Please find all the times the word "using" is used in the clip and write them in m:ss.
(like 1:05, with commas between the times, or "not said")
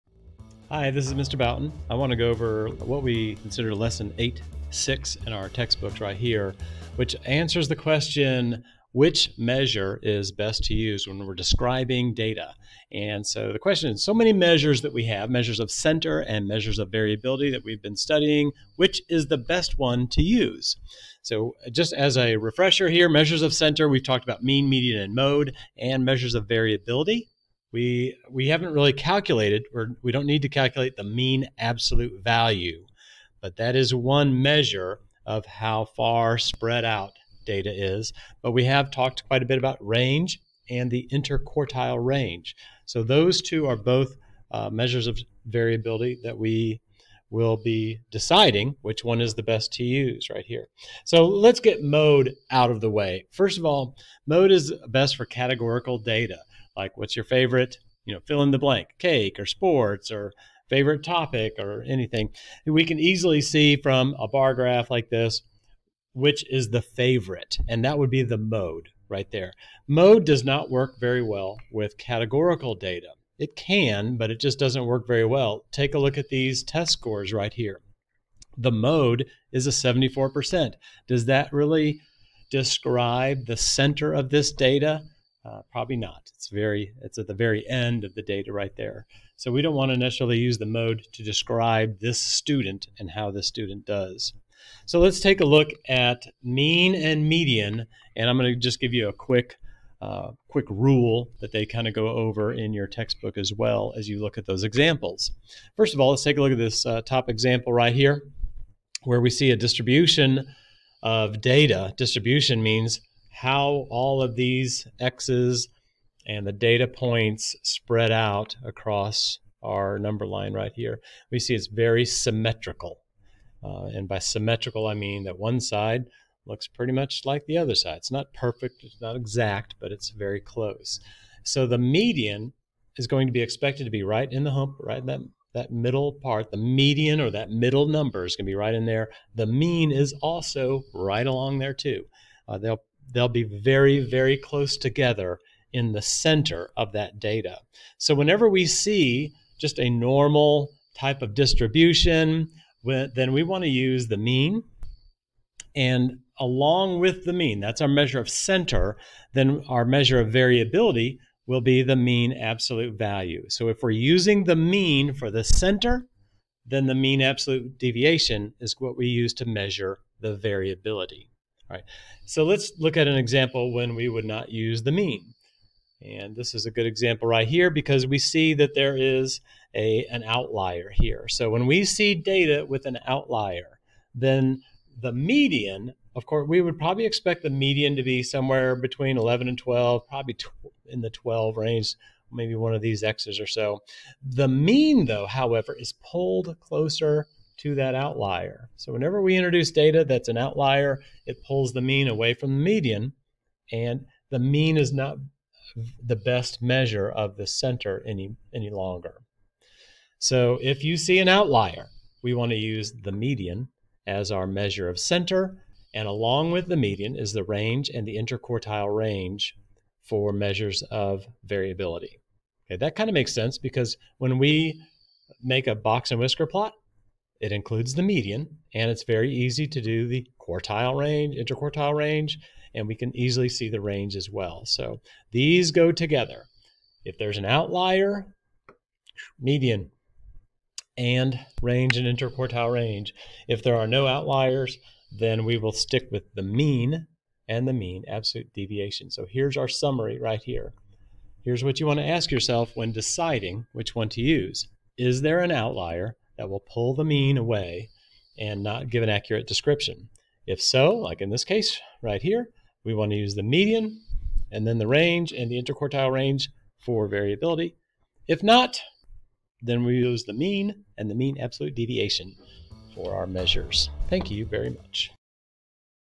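2:43.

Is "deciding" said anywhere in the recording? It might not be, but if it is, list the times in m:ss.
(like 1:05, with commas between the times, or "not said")
0:48, 4:12.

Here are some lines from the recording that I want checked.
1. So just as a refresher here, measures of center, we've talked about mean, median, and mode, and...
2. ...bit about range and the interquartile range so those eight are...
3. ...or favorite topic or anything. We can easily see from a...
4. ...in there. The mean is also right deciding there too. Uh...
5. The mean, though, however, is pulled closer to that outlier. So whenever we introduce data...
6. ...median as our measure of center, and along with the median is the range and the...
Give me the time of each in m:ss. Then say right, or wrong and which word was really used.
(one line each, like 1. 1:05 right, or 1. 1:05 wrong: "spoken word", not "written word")
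1. 0:21 right
2. 0:39 wrong: "two", not "eight"
3. 1:00 right
4. 2:18 wrong: "along", not "deciding"
5. 3:14 right
6. 3:33 right.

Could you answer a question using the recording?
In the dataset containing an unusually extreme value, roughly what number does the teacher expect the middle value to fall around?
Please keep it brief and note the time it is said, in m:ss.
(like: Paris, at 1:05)
12, at 3:11.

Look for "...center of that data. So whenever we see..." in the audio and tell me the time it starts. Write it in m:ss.
2:26.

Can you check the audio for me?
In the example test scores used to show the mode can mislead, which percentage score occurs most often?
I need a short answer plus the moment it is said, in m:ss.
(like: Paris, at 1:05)
74%, at 1:19.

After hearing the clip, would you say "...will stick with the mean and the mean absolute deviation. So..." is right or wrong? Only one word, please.
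right.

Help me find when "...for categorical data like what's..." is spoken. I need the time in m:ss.
0:55.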